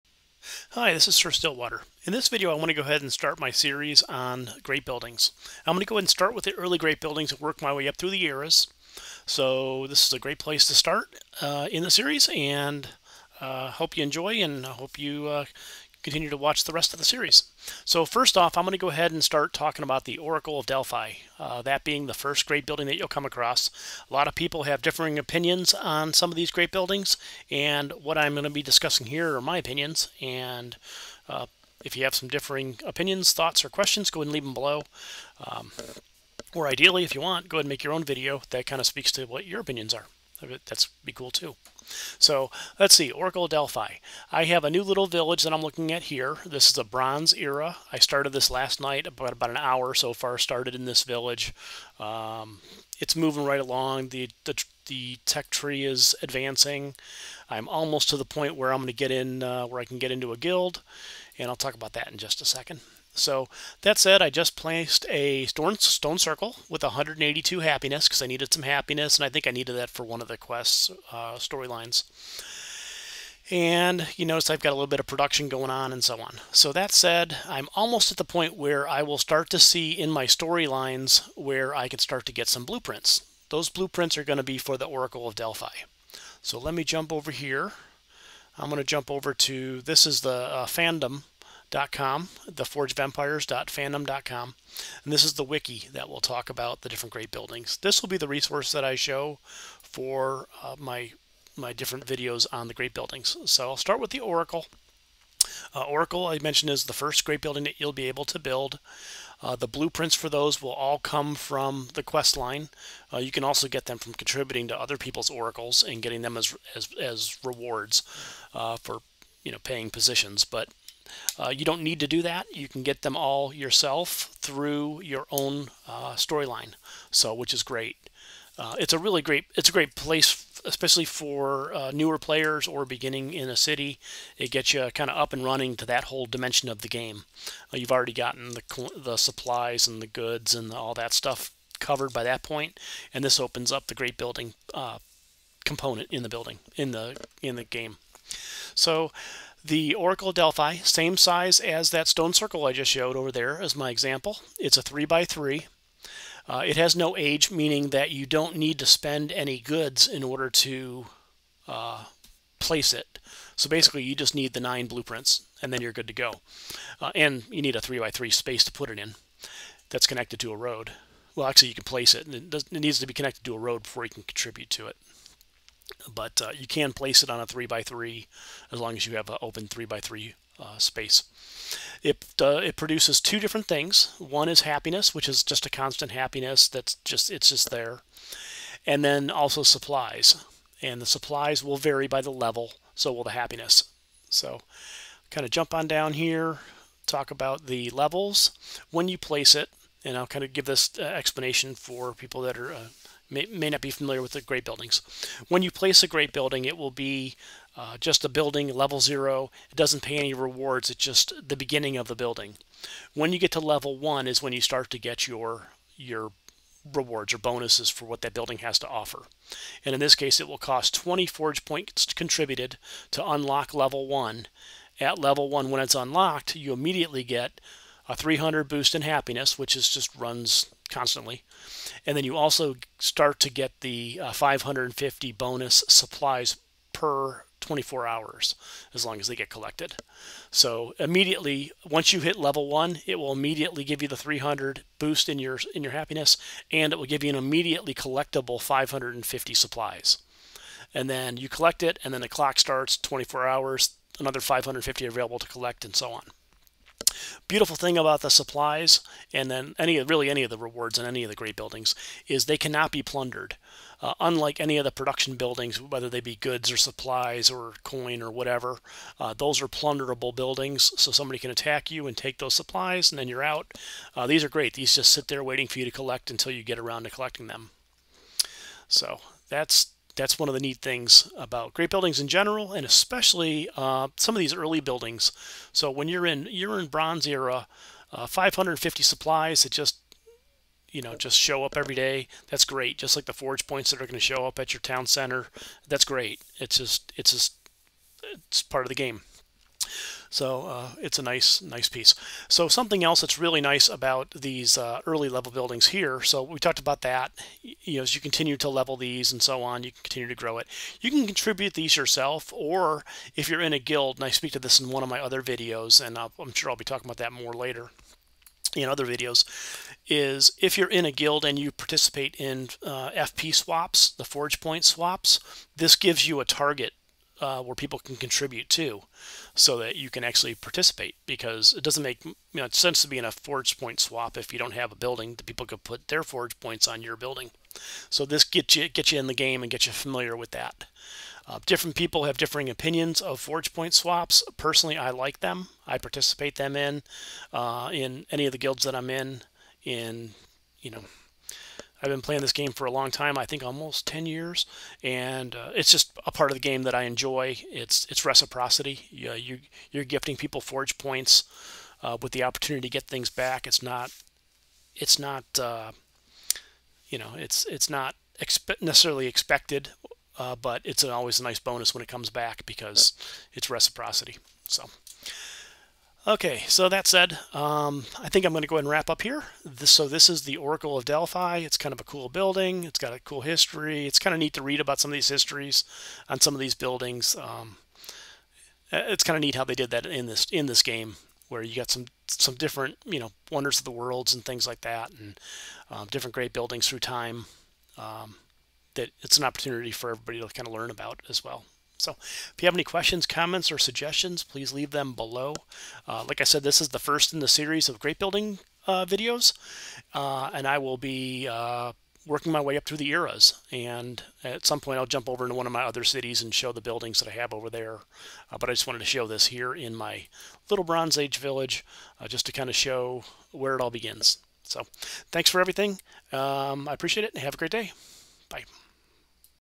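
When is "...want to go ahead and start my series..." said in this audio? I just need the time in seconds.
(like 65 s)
2 s.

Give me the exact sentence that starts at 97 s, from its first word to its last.
This will be the resource that I show for uh, my my different videos on the great buildings.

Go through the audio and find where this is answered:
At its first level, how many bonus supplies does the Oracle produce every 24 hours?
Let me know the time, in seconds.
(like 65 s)
234 s.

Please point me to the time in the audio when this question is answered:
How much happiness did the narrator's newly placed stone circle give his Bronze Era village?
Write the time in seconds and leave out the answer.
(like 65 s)
66 s.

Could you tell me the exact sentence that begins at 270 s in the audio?
So somebody can attack you and take those supplies, and then you're out.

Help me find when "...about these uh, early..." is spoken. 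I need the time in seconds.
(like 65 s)
303 s.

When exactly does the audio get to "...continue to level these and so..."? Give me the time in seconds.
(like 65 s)
308 s.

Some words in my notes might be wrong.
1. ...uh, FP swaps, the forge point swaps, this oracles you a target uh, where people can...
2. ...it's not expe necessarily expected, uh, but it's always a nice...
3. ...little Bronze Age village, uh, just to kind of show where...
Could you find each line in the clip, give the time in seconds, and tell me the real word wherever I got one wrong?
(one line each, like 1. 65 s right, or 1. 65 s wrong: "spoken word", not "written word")
1. 322 s wrong: "gives", not "oracles"
2. 367 s right
3. 420 s right.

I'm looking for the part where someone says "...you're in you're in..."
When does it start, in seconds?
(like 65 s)
286 s.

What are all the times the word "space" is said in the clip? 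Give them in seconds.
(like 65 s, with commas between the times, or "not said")
168 s, 180 s.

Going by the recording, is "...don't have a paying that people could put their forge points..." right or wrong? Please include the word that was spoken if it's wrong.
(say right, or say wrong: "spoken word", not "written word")
wrong: "building", not "paying".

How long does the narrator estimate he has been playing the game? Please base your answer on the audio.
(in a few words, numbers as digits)
almost 10 years.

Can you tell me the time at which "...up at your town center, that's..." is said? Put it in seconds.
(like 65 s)
294 s.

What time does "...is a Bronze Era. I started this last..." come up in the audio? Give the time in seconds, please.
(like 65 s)
46 s.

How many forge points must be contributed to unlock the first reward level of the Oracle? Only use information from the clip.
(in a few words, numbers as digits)
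20.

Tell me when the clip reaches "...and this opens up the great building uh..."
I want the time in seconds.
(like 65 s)
143 s.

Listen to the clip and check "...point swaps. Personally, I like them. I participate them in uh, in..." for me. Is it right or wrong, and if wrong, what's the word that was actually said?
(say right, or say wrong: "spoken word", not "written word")
right.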